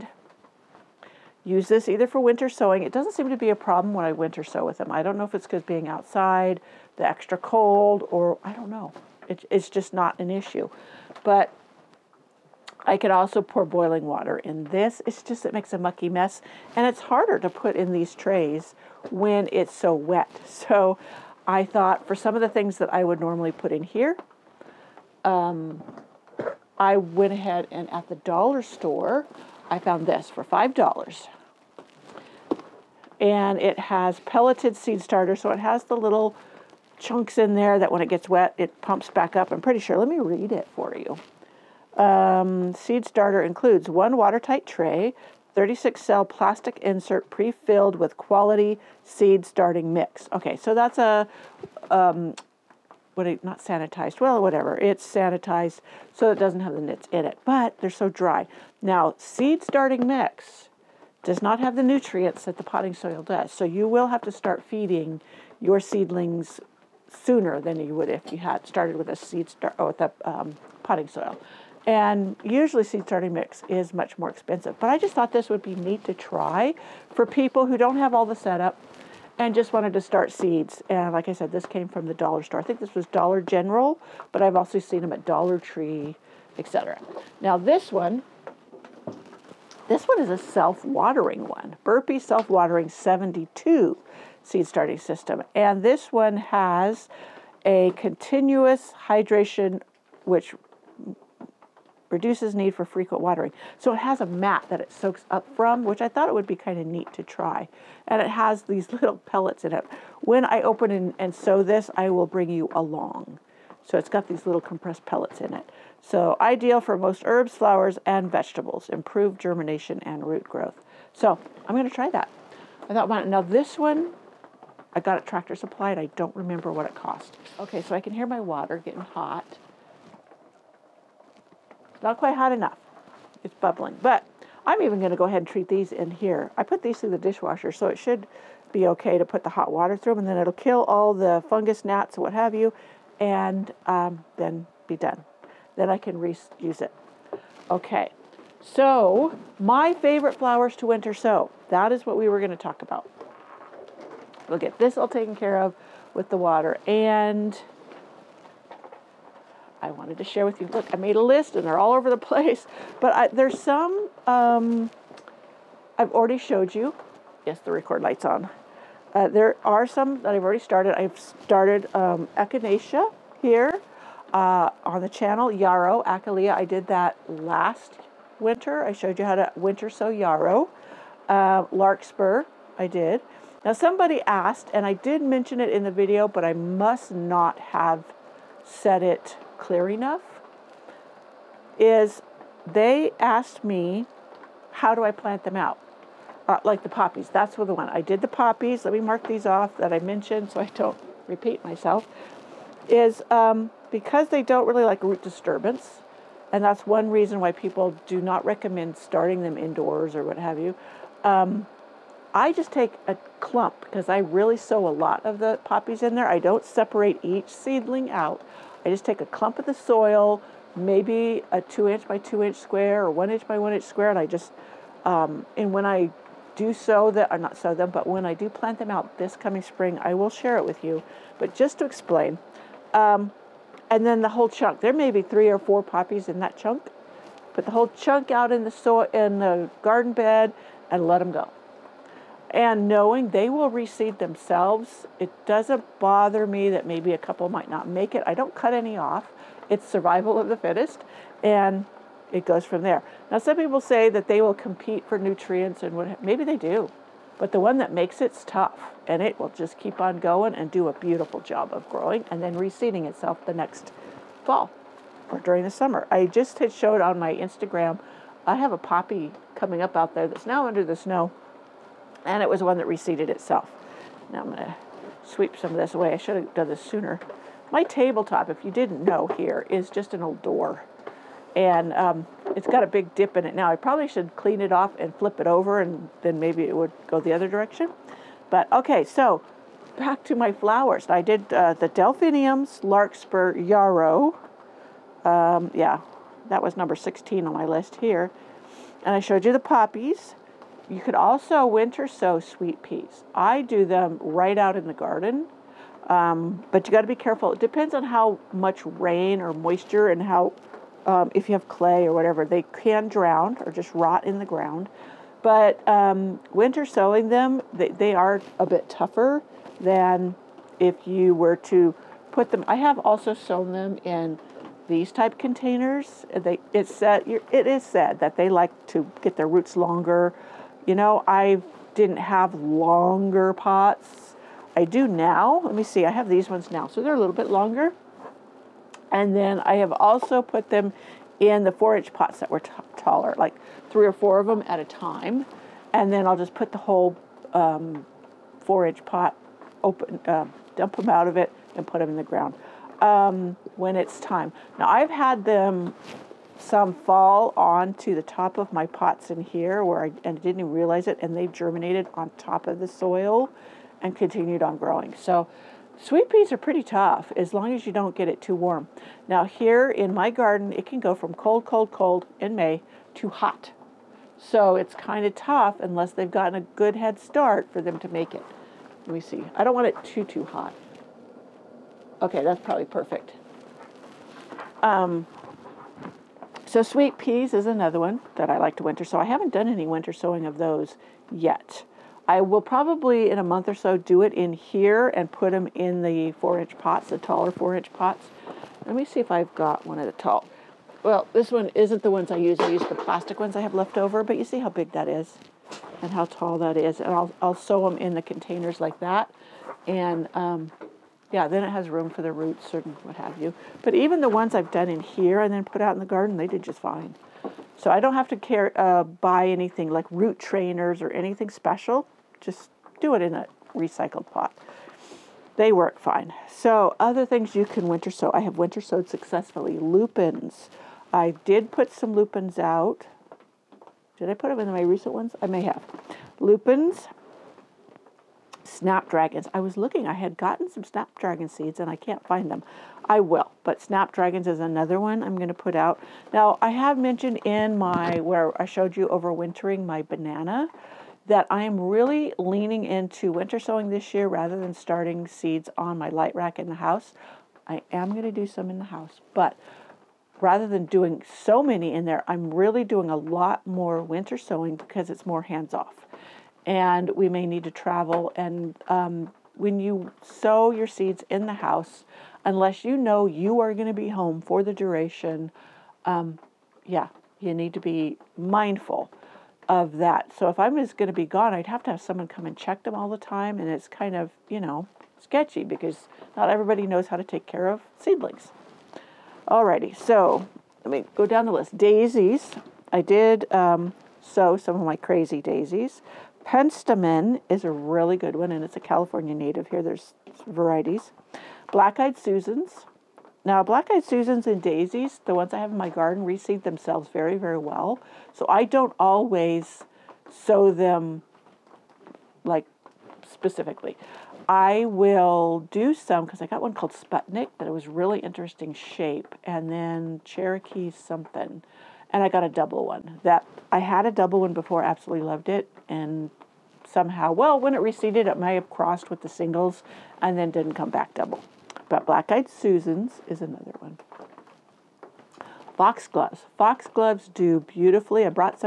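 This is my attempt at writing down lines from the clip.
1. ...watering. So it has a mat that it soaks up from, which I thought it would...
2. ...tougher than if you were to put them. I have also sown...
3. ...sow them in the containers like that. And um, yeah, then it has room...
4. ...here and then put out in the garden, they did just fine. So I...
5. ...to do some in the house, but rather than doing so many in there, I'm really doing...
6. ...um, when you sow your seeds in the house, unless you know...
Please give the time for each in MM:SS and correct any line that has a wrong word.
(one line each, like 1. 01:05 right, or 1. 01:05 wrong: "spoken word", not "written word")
1. 01:43 right
2. 05:18 right
3. 06:47 right
4. 06:54 right
5. 07:38 right
6. 07:48 right.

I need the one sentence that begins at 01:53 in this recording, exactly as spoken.
So it's got these little compressed pellets in it.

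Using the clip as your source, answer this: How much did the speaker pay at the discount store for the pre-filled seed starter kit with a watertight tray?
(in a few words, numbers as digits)
$5.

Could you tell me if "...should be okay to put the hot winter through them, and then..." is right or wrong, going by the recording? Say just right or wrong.
wrong.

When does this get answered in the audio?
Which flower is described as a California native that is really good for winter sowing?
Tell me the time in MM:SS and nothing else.
08:16.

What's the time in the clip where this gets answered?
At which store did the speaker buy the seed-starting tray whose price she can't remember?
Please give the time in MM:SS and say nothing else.
02:05.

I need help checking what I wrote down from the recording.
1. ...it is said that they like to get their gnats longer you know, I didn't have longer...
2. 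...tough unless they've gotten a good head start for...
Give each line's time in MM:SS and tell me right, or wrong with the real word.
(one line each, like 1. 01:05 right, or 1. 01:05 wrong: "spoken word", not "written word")
1. 05:27 wrong: "roots", not "gnats"
2. 06:15 right.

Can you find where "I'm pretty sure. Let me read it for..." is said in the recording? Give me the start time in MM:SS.
00:39.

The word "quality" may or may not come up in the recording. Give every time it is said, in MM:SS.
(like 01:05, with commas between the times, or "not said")
00:48.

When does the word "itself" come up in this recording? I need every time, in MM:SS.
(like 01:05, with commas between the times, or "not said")
04:23, 04:33.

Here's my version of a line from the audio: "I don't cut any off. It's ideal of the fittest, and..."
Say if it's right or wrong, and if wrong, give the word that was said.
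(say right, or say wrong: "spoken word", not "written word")
wrong: "survival", not "ideal".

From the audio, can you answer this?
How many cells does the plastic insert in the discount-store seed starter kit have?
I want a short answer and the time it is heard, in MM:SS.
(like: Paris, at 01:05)
36, at 00:45.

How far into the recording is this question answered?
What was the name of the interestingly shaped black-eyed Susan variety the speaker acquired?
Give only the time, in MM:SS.
08:36.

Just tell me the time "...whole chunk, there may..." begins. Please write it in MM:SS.
03:54.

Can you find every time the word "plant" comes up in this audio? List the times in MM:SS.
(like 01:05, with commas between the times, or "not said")
03:15, 03:48.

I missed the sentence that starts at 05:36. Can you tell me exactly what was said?
I have these ones now, so they're a little bit longer.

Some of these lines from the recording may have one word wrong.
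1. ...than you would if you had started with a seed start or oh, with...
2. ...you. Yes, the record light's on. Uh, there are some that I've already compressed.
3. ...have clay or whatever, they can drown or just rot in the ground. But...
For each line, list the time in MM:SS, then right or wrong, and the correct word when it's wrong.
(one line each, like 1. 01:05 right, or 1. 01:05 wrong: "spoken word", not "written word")
1. 01:07 right
2. 02:46 wrong: "started", not "compressed"
3. 05:11 right.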